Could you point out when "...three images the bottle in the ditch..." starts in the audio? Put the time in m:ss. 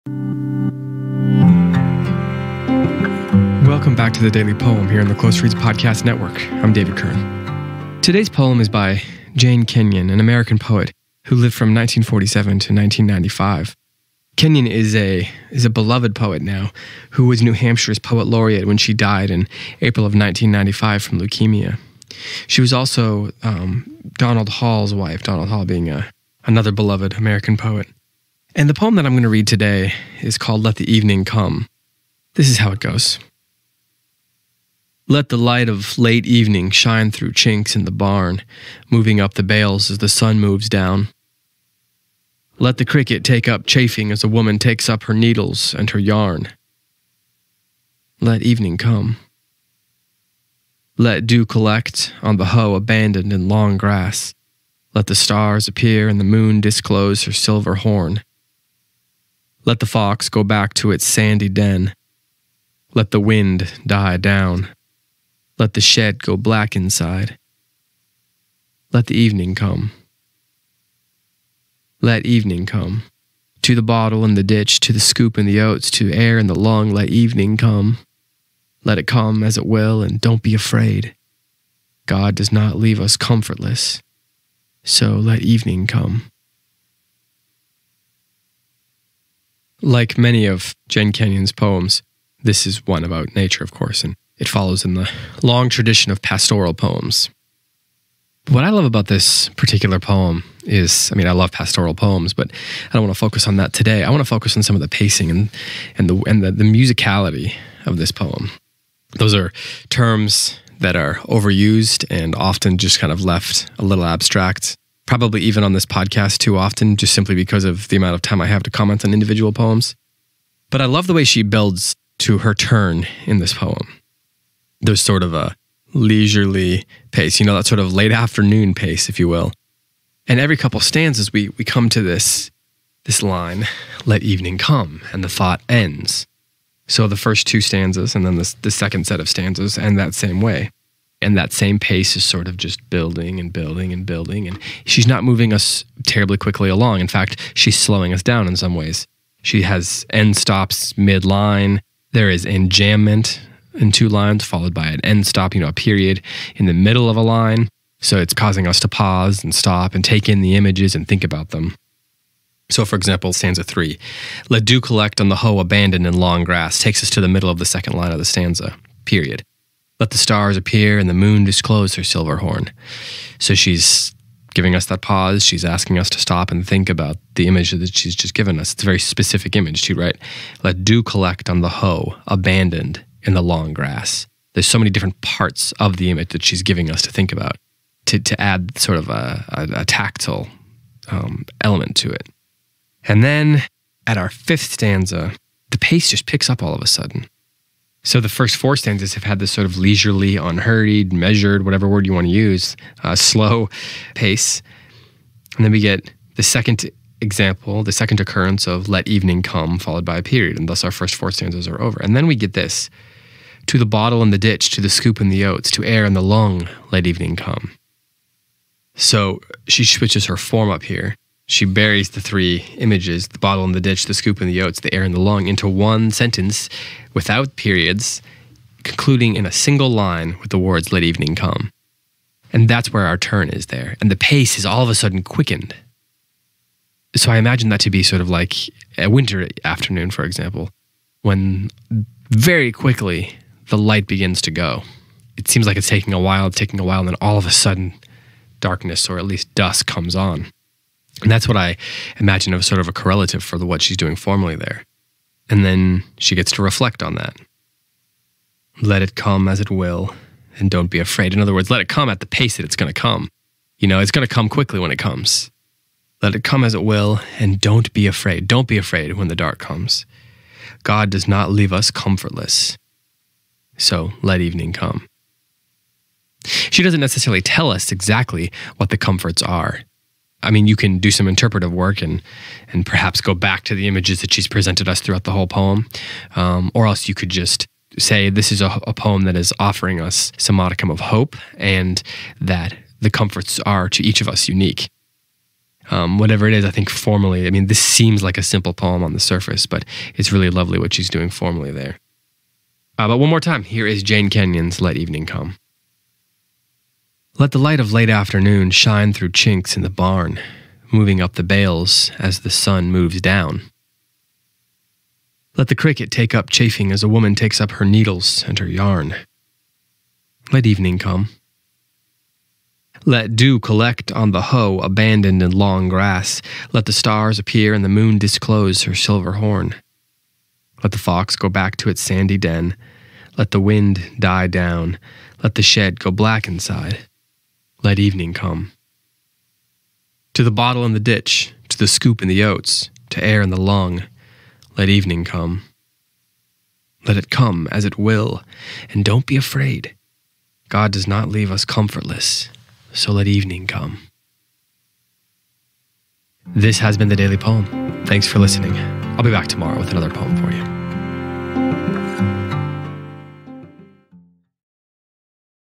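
3:42.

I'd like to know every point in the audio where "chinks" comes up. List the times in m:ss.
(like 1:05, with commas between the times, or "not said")
0:37, 5:09.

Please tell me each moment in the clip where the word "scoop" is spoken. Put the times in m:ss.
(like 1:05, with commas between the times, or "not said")
1:14, 3:34, 3:44, 5:41.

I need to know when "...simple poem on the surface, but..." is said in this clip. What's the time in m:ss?
4:58.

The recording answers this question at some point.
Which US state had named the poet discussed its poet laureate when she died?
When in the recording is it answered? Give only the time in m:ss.
0:17.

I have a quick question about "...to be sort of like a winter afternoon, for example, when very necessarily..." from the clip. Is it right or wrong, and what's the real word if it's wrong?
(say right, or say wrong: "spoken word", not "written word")
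wrong: "quickly", not "necessarily".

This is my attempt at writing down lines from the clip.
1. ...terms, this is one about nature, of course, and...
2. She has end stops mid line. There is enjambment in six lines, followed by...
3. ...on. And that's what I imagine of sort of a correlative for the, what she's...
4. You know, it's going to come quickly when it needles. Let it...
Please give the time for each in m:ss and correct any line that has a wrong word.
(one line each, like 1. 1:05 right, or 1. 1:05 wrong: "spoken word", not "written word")
1. 1:31 wrong: "poems", not "terms"
2. 2:29 wrong: "two", not "six"
3. 4:10 right
4. 4:23 wrong: "comes", not "needles".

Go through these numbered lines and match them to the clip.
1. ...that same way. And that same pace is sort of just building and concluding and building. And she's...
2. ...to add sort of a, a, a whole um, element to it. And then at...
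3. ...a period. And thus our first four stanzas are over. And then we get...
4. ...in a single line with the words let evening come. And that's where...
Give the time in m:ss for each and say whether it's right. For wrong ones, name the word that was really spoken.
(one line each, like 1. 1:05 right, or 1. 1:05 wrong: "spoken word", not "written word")
1. 2:19 wrong: "building", not "concluding"
2. 3:08 wrong: "tactile", not "whole"
3. 3:30 right
4. 3:49 right.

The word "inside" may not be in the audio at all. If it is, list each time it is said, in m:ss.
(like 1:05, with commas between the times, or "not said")
1:06, 5:36.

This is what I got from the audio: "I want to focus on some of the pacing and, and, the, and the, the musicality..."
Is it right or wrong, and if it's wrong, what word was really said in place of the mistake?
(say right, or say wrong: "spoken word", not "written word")
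right.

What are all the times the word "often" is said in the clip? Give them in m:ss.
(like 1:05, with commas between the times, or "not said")
1:52, 1:56.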